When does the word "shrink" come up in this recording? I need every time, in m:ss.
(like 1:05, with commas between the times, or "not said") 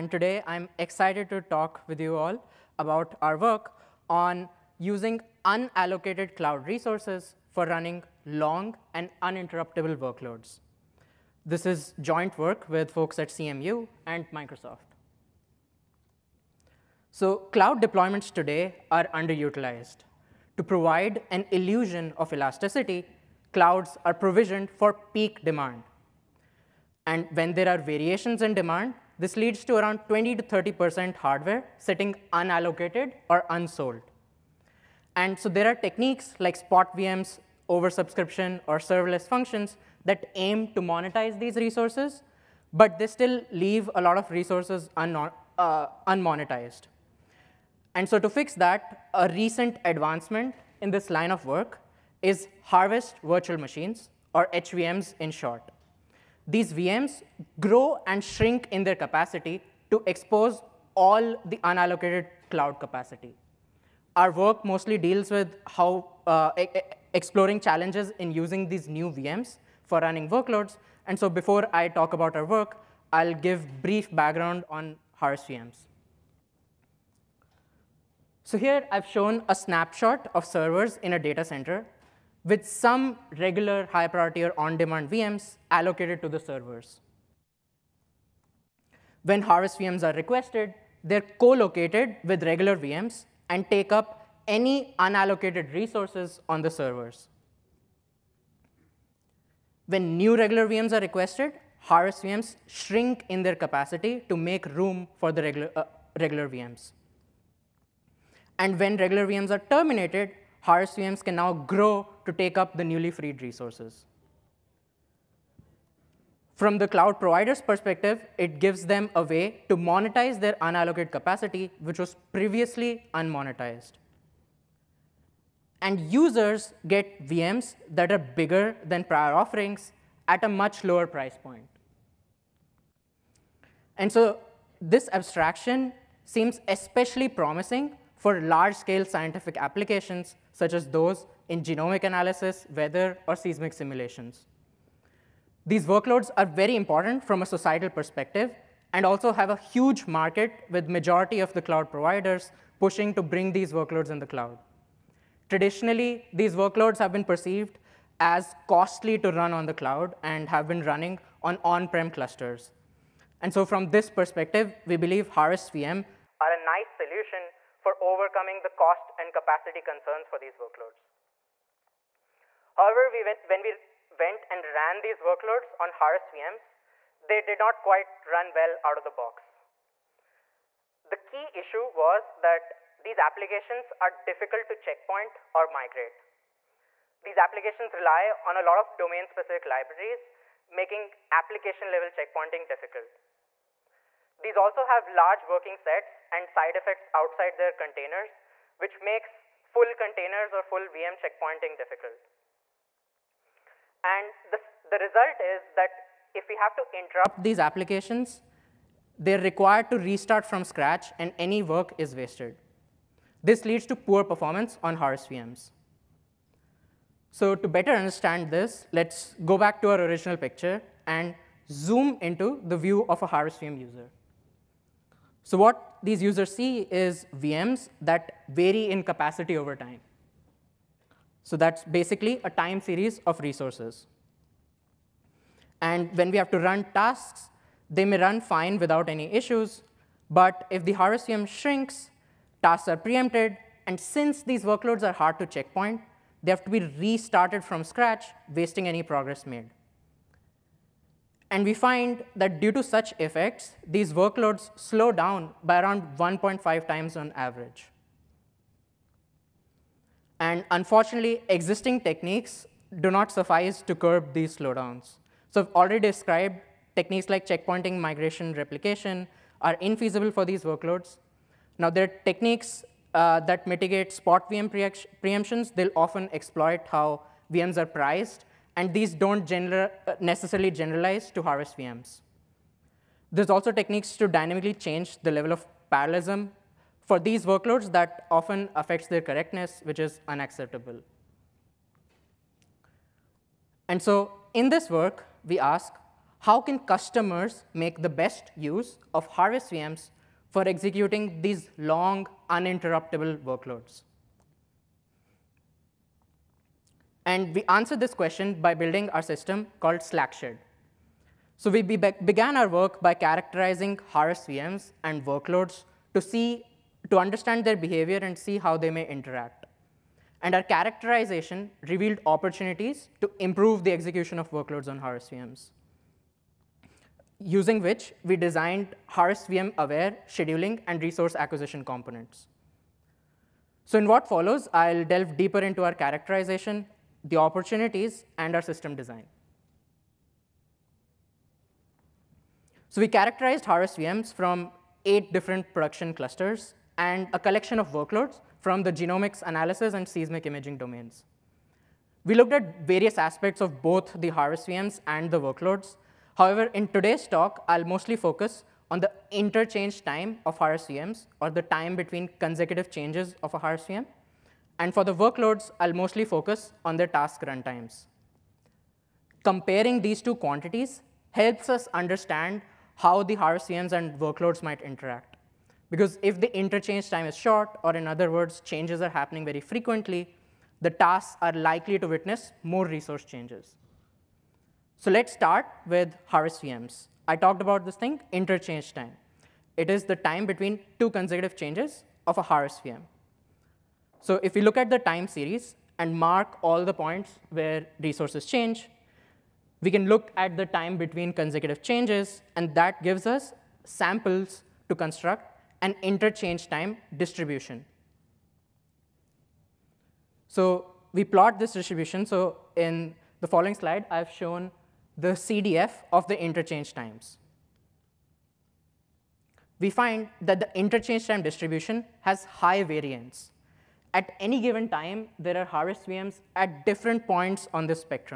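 0:58, 1:42, 4:01.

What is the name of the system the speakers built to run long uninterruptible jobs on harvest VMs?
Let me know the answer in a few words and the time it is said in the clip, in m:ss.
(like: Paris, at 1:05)
SlackSched, at 5:09.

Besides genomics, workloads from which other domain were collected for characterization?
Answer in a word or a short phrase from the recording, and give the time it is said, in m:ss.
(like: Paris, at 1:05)
seismic imaging, at 5:50.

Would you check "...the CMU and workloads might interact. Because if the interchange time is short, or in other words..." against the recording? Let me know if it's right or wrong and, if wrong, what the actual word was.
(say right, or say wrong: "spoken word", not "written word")
wrong: "HVMs", not "CMU".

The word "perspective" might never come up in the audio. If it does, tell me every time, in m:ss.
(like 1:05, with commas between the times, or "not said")
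1:57, 2:27, 2:44.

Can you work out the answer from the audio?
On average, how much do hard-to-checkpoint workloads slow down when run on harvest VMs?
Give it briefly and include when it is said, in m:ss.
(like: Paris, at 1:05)
1.5 times, at 4:16.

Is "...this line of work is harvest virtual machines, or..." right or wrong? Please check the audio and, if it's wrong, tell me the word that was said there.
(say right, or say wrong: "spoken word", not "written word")
right.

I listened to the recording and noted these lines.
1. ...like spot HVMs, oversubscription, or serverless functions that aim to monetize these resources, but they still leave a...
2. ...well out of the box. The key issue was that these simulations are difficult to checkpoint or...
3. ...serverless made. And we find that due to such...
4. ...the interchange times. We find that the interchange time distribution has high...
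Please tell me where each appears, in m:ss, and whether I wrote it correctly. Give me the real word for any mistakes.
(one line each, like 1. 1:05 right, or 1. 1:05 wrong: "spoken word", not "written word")
1. 0:36 wrong: "VMs", not "HVMs"
2. 2:58 wrong: "applications", not "simulations"
3. 4:09 wrong: "progress", not "serverless"
4. 6:56 right.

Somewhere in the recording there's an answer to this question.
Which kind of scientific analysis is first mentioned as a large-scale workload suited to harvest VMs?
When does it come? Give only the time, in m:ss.
2:21.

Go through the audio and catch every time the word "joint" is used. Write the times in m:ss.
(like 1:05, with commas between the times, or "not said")
0:12.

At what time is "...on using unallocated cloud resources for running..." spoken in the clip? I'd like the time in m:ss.
0:04.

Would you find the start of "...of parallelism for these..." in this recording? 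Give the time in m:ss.
4:45.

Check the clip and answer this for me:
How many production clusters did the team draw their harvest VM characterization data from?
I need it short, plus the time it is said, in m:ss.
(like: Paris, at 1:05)
8, at 5:45.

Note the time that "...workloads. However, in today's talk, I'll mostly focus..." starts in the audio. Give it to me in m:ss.
5:55.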